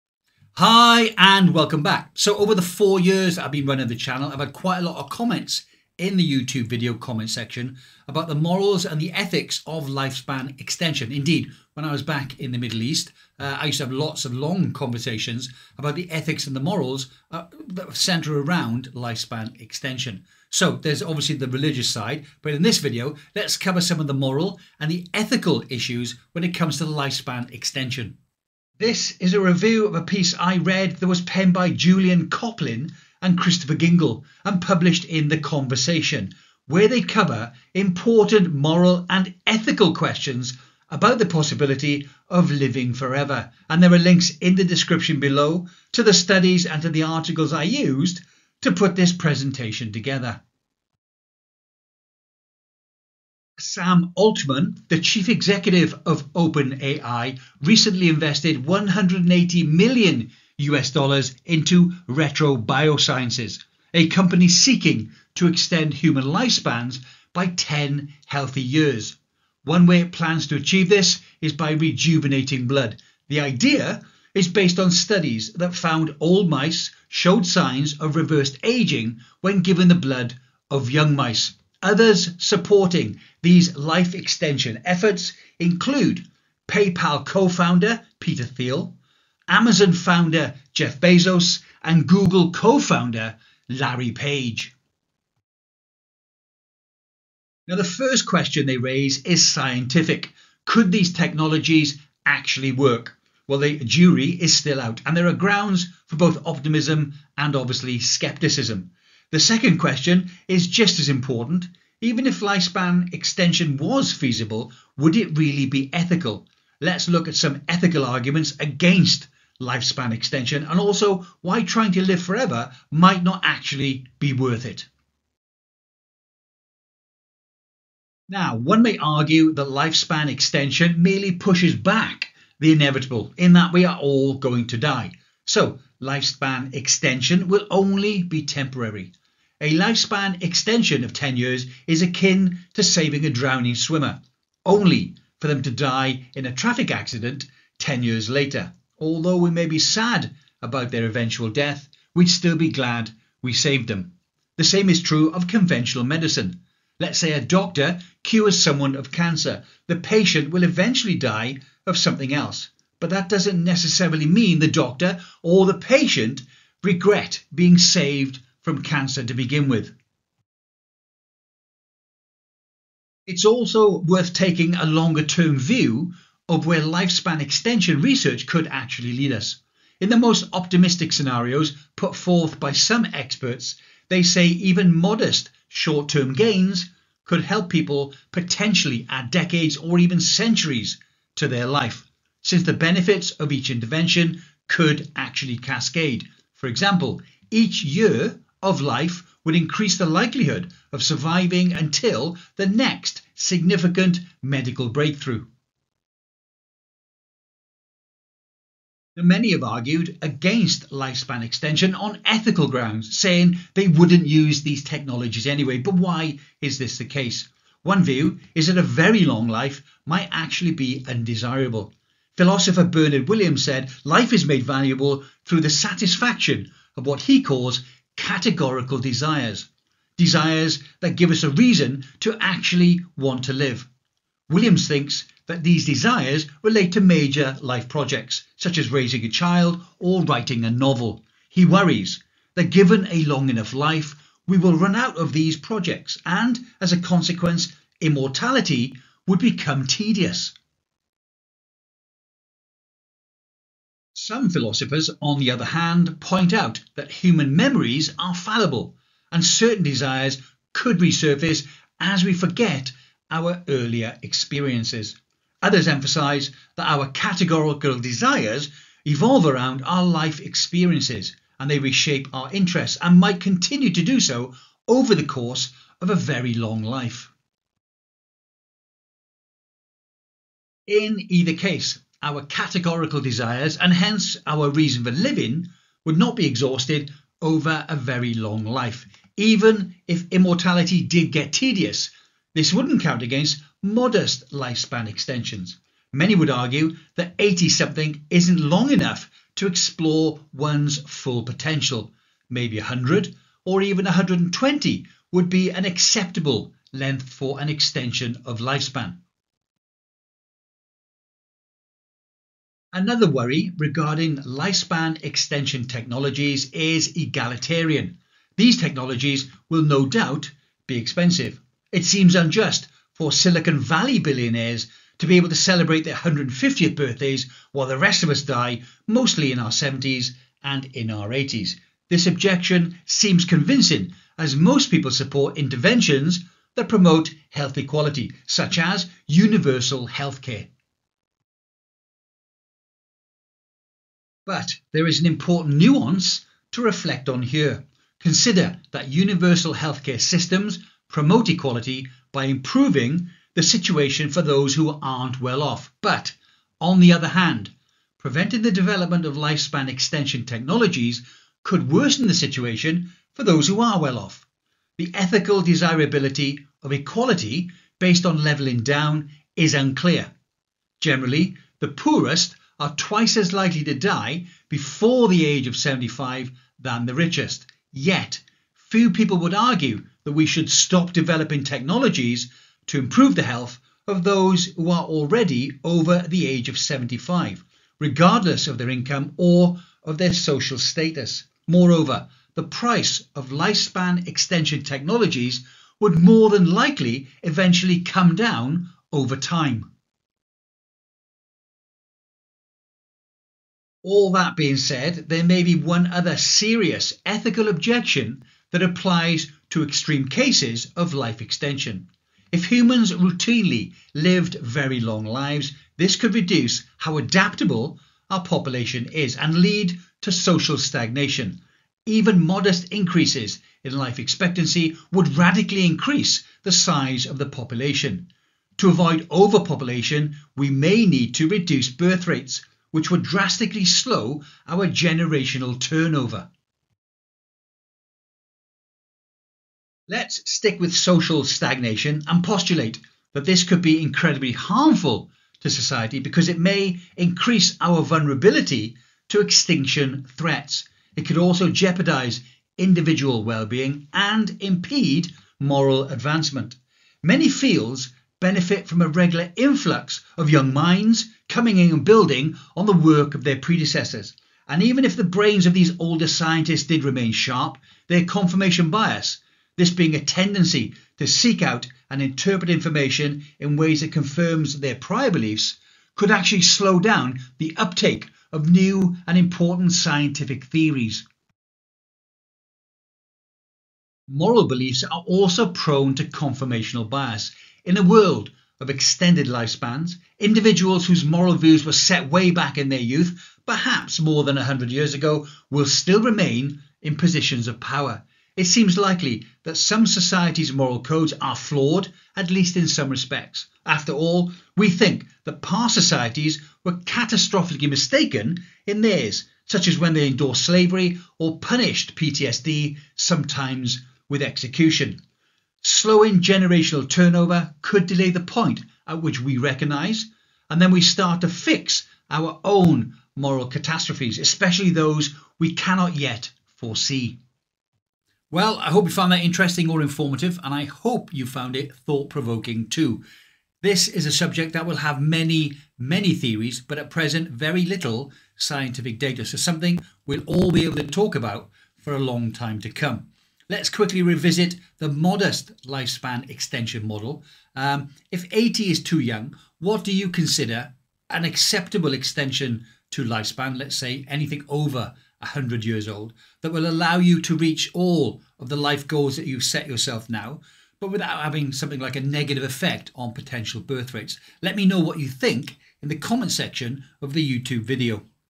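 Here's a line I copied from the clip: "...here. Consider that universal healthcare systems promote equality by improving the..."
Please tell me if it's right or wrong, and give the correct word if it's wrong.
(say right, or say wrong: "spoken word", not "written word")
right.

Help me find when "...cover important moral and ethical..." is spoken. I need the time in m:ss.
0:37.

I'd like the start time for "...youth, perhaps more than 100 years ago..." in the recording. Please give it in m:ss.
8:12.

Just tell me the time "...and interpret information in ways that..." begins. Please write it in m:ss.
7:52.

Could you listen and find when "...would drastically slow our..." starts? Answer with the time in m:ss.
7:13.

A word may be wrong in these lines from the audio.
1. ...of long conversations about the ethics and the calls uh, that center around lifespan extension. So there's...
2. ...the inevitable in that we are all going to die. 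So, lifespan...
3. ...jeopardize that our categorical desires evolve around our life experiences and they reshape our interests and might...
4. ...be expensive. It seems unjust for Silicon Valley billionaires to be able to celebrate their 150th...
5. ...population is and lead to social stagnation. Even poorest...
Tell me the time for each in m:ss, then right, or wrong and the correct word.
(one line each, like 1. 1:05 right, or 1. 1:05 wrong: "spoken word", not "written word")
1. 0:14 wrong: "morals", not "calls"
2. 2:12 right
3. 4:25 wrong: "emphasize", not "jeopardize"
4. 5:20 right
5. 6:58 wrong: "modest", not "poorest".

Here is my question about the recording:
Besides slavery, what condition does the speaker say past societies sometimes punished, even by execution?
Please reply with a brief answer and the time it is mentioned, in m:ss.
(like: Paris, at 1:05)
PTSD, at 8:32.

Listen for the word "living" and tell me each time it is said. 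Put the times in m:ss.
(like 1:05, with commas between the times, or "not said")
0:42, 4:45.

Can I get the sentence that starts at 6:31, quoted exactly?
Moreover, the price of lifespan extension technologies would more than likely eventually come down over time.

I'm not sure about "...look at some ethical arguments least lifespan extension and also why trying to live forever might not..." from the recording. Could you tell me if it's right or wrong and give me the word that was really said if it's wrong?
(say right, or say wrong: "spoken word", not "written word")
wrong: "against", not "least".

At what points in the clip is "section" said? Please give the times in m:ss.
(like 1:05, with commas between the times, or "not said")
0:07, 9:26.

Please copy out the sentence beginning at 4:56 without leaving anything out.
Many would argue that 80 something isn't long enough to explore one's full potential.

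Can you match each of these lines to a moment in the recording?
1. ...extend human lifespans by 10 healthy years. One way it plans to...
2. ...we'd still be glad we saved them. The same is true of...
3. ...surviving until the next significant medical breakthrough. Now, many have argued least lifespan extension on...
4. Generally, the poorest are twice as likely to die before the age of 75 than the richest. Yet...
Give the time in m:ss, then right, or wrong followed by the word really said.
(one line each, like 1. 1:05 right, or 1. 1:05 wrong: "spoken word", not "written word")
1. 1:05 right
2. 2:32 right
3. 3:21 wrong: "against", not "least"
4. 6:10 right.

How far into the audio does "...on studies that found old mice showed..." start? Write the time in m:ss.
1:14.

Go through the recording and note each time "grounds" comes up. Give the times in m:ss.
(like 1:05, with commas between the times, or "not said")
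1:45, 3:32.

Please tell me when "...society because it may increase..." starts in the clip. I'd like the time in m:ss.
7:25.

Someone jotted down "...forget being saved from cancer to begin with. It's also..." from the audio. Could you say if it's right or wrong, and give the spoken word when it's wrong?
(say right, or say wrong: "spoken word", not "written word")
wrong: "regret", not "forget".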